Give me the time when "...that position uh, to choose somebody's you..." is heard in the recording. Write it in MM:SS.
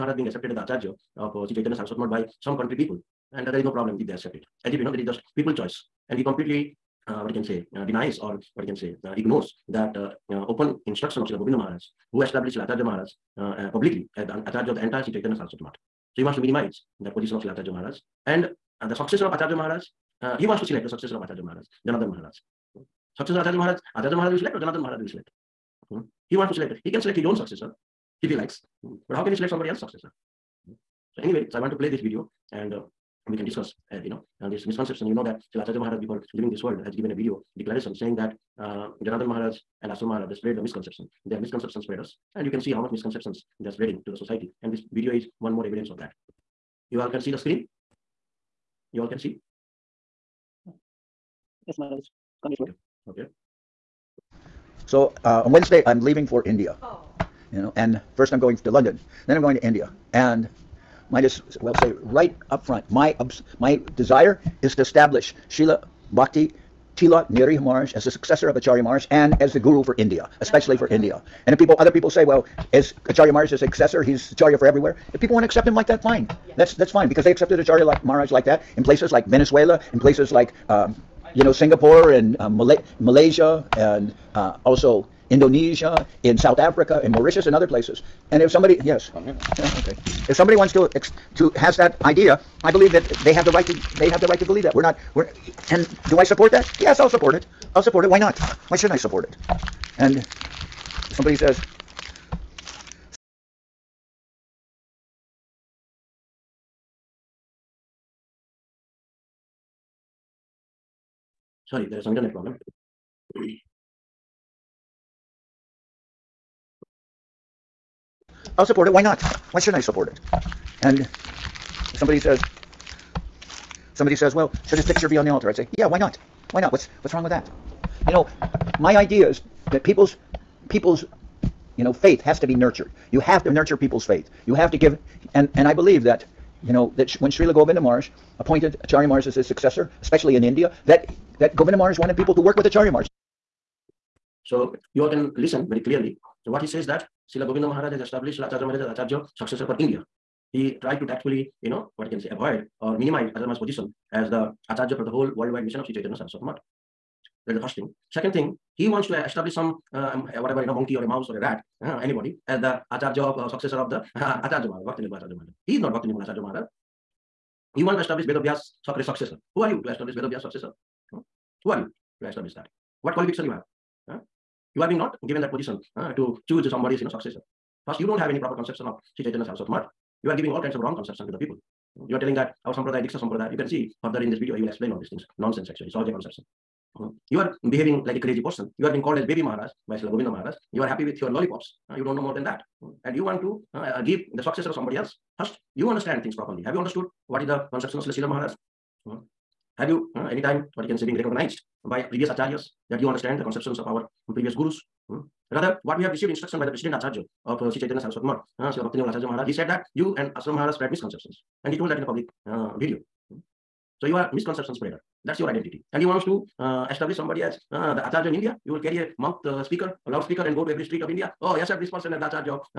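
02:55.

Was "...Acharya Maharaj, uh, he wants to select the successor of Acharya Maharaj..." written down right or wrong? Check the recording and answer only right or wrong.
right.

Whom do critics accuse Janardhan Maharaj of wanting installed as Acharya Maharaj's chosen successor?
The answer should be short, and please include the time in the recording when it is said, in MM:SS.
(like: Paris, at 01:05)
Srila Bhakti Tilak Niriha Maharaj, at 01:05.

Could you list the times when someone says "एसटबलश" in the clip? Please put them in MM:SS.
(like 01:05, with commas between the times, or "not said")
02:39, 02:48.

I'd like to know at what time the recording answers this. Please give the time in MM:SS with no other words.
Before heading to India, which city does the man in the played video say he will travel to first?
00:58.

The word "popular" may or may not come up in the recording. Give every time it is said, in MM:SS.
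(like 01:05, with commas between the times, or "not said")
not said.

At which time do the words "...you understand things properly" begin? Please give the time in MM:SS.
03:15.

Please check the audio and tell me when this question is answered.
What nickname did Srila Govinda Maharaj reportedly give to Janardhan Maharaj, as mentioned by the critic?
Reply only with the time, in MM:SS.
03:09.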